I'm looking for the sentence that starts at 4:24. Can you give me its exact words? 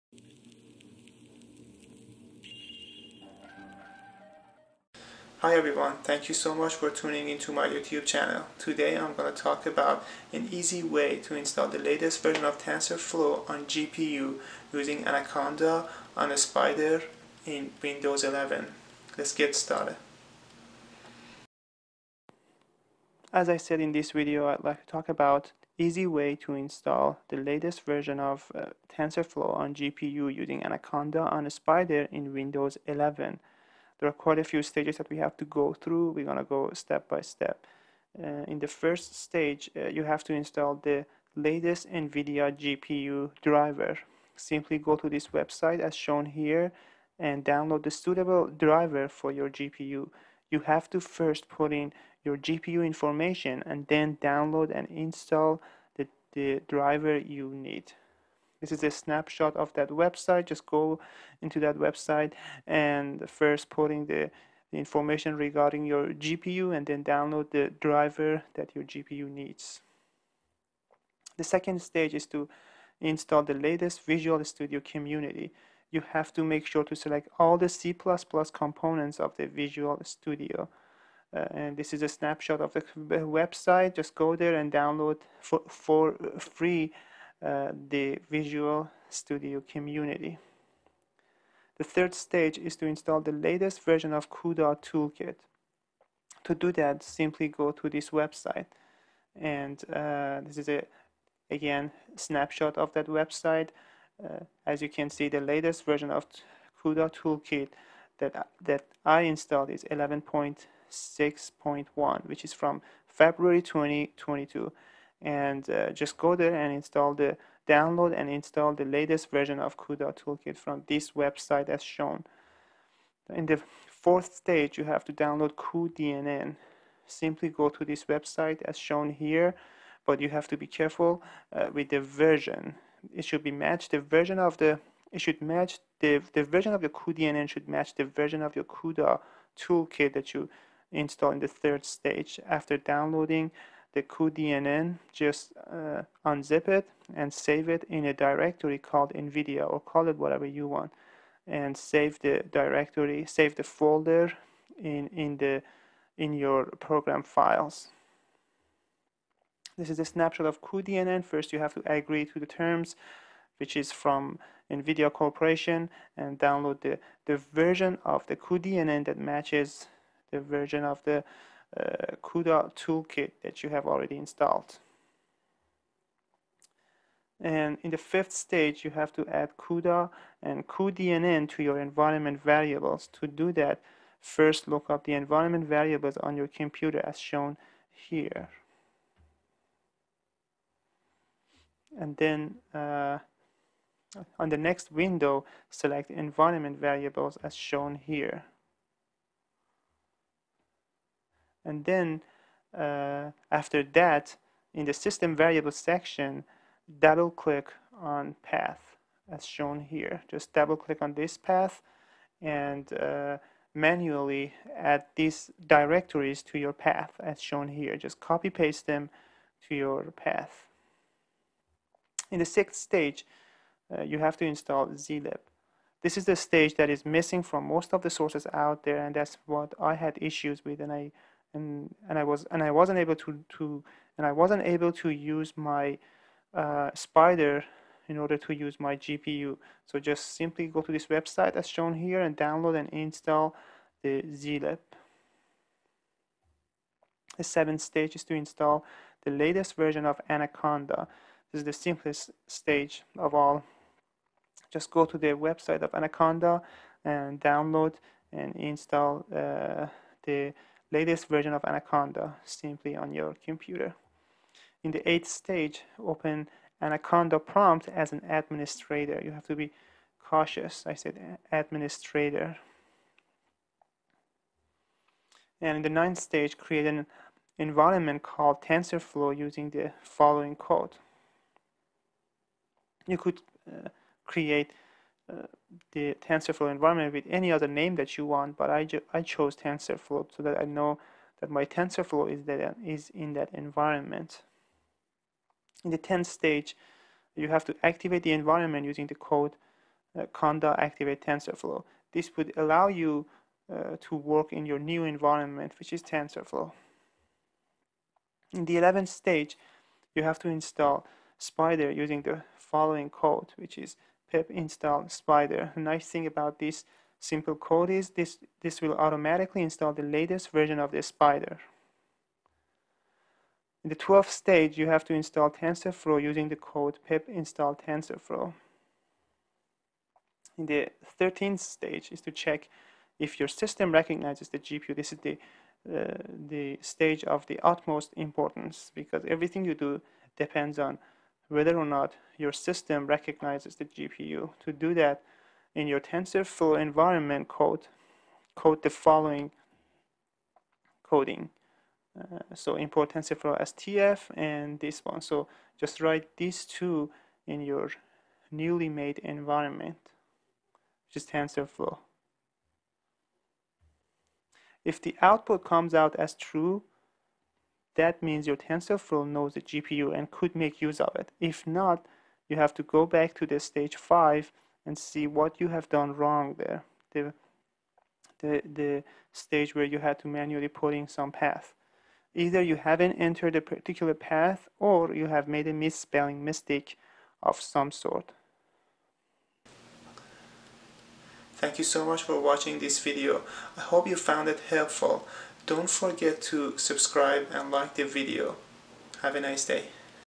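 In the eighth stage, open Anaconda prompt as an administrator.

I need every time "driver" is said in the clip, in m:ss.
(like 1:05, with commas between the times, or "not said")
0:43, 0:48, 0:56, 1:07.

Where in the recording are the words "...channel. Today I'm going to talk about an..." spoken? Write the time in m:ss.
0:08.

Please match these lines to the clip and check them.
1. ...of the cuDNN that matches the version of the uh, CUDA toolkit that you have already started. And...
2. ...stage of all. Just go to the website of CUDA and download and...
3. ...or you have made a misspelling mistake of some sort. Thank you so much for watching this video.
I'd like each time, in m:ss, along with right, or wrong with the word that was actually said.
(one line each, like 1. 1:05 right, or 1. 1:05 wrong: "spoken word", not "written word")
1. 2:48 wrong: "installed", not "started"
2. 4:12 wrong: "Anaconda", not "CUDA"
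3. 6:24 right.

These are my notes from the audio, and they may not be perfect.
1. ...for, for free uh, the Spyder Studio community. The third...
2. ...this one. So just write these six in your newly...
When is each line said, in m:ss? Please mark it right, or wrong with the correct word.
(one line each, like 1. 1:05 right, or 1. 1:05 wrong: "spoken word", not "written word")
1. 1:25 wrong: "Visual", not "Spyder"
2. 5:54 wrong: "two", not "six".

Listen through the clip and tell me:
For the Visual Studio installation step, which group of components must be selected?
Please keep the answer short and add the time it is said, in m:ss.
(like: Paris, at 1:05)
C++ components, at 1:17.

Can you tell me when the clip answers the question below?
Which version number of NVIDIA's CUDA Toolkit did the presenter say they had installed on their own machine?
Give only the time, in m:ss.
1:49.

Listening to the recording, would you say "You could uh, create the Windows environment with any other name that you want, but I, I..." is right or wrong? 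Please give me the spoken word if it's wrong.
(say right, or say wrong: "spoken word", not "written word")
wrong: "TensorFlow", not "Windows".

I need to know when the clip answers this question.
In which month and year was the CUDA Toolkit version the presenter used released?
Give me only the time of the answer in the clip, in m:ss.
1:53.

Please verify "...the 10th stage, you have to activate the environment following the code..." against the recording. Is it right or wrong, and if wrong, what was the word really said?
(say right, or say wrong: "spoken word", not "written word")
wrong: "using", not "following".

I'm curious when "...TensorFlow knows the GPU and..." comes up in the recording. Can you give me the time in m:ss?
6:08.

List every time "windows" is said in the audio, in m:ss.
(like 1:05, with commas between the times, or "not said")
0:17, 0:32, 3:14.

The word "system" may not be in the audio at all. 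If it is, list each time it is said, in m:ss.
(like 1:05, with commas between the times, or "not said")
3:24, 5:33, 5:42.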